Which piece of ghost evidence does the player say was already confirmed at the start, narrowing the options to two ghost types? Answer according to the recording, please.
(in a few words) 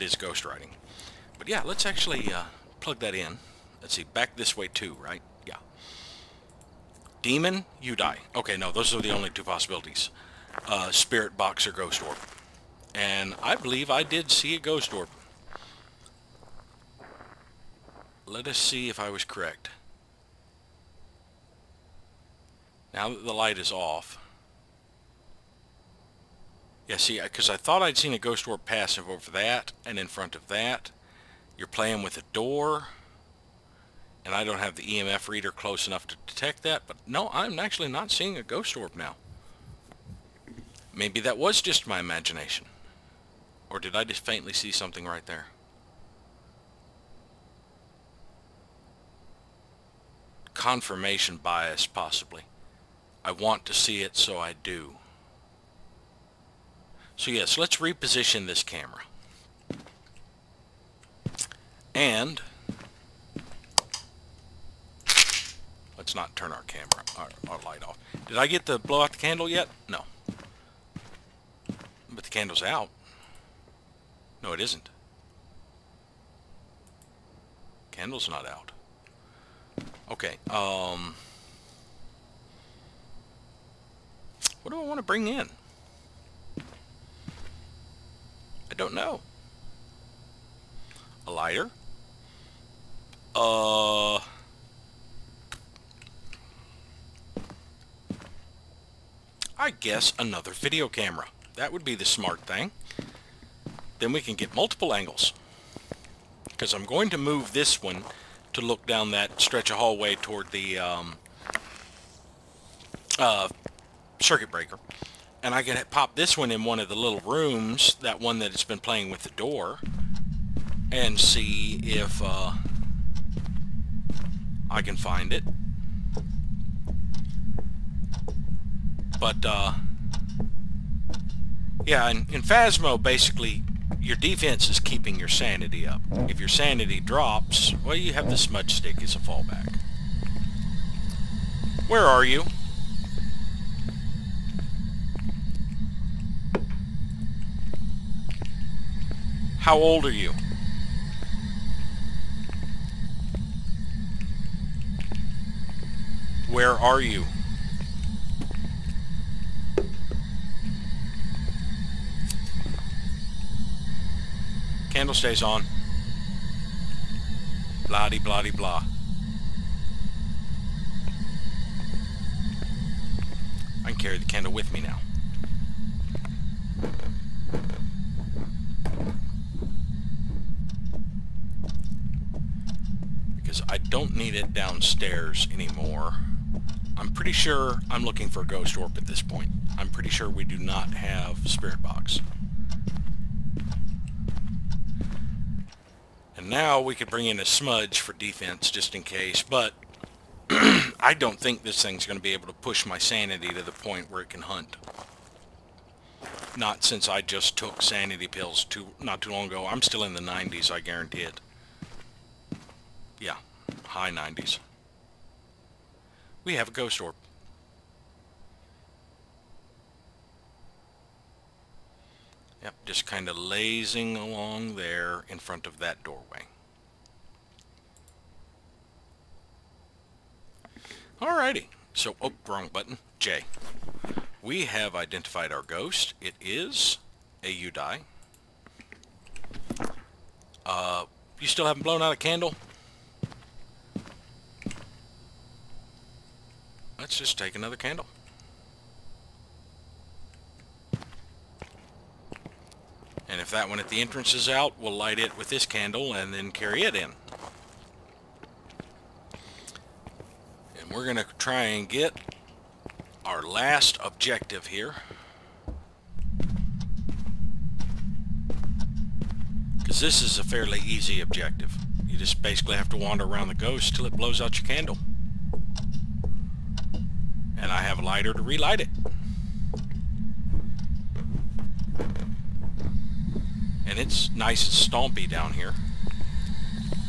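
Ghost writing.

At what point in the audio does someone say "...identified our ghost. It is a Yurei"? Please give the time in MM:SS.
03:54.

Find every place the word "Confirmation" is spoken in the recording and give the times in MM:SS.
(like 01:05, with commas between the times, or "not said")
00:50.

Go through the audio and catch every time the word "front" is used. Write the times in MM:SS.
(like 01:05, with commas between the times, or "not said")
00:30, 03:45.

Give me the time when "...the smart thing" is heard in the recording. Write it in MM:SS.
01:41.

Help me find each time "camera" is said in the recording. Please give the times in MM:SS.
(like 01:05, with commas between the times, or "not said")
00:58, 01:06, 01:40.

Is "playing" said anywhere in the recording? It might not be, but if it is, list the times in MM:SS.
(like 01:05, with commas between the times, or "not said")
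00:31, 01:58.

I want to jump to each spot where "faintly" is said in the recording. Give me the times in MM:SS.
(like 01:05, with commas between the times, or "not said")
00:44.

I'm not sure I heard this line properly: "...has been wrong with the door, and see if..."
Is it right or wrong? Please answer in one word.
wrong.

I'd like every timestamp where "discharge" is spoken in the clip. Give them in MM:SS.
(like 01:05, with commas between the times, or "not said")
not said.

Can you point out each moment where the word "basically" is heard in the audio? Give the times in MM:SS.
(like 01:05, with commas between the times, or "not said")
02:13, 04:32.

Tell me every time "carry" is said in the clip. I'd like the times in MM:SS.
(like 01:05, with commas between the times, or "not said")
02:53, 04:16.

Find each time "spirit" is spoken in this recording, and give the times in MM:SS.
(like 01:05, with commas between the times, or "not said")
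00:10, 03:11.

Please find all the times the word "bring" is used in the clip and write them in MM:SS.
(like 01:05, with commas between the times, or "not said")
01:25, 03:17.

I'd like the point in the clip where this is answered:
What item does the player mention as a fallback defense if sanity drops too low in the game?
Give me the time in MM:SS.
02:18.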